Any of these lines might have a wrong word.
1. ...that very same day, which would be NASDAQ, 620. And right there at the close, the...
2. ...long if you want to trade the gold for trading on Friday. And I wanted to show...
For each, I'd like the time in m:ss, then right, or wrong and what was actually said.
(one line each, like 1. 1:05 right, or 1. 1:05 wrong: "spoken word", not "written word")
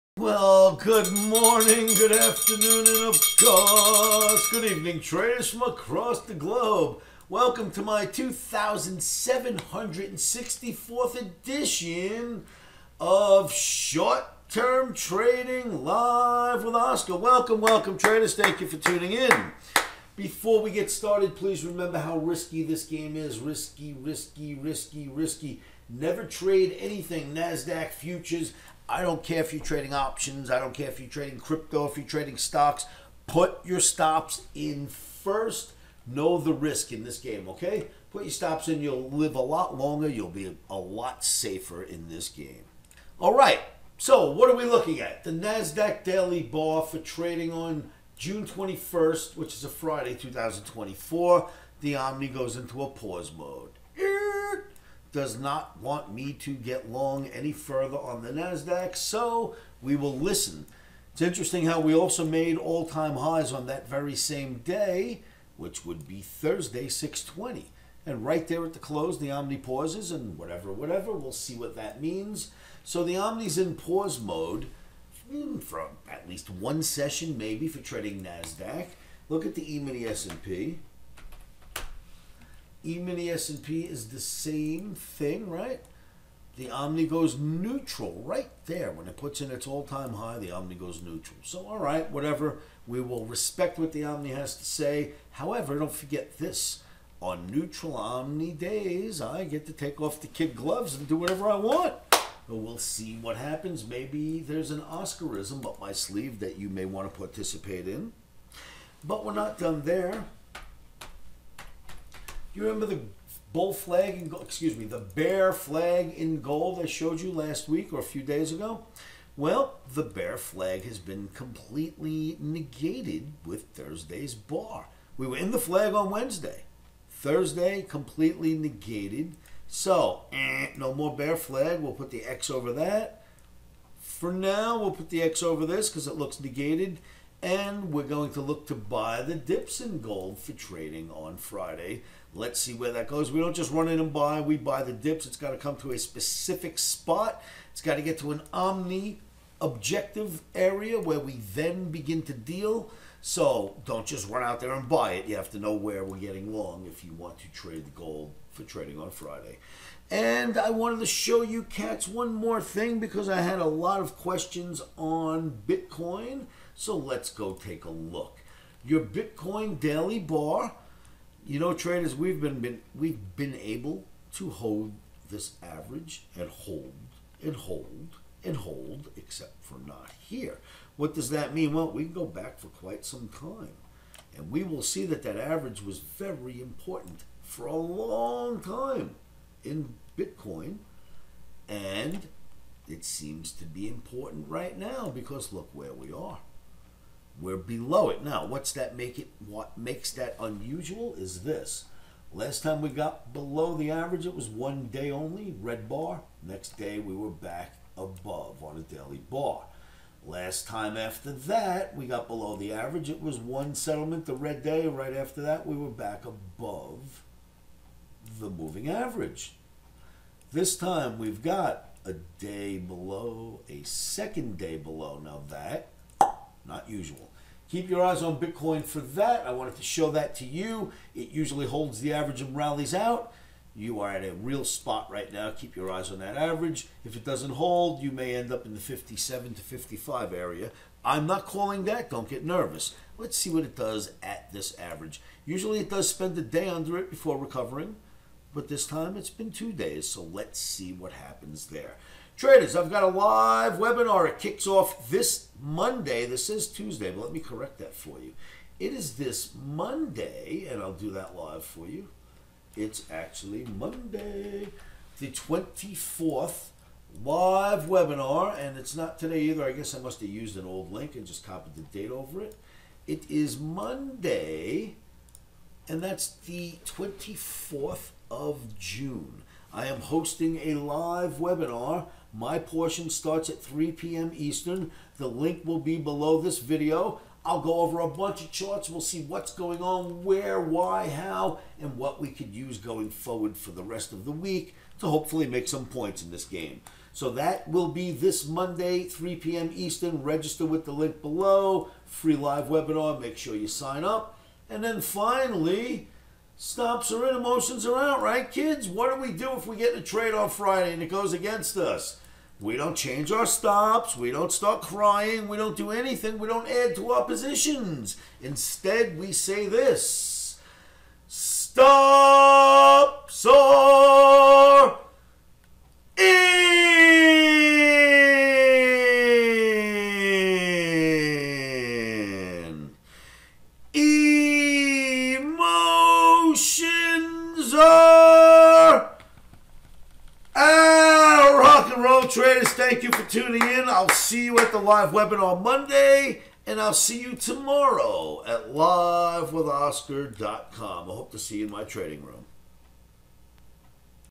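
1. 1:03 wrong: "Thursday", not "NASDAQ"
2. 2:36 right.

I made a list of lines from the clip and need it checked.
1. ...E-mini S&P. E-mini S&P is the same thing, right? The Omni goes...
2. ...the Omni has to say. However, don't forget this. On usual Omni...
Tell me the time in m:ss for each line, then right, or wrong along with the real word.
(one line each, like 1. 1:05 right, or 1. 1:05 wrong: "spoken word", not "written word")
1. 1:19 right
2. 1:33 wrong: "neutral", not "usual".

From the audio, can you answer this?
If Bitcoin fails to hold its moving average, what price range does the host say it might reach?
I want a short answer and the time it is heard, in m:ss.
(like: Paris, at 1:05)
57 to 55, at 3:58.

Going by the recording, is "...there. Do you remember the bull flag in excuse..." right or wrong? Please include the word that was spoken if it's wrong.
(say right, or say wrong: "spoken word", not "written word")
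right.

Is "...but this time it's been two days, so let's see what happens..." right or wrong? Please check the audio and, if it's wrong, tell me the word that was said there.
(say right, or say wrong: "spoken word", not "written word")
right.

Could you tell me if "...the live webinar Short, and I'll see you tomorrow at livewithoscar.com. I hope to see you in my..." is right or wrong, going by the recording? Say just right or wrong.
wrong.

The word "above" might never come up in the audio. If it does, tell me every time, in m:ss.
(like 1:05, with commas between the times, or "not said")
3:27, 3:36.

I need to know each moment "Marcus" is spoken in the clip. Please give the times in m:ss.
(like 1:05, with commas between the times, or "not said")
not said.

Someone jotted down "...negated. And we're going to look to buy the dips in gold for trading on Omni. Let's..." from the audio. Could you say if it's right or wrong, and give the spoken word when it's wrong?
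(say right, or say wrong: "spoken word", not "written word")
wrong: "Friday", not "Omni".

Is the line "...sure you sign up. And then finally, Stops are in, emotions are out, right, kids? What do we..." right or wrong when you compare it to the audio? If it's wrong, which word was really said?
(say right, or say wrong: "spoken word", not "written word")
right.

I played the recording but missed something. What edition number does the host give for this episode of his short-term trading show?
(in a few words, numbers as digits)
2764.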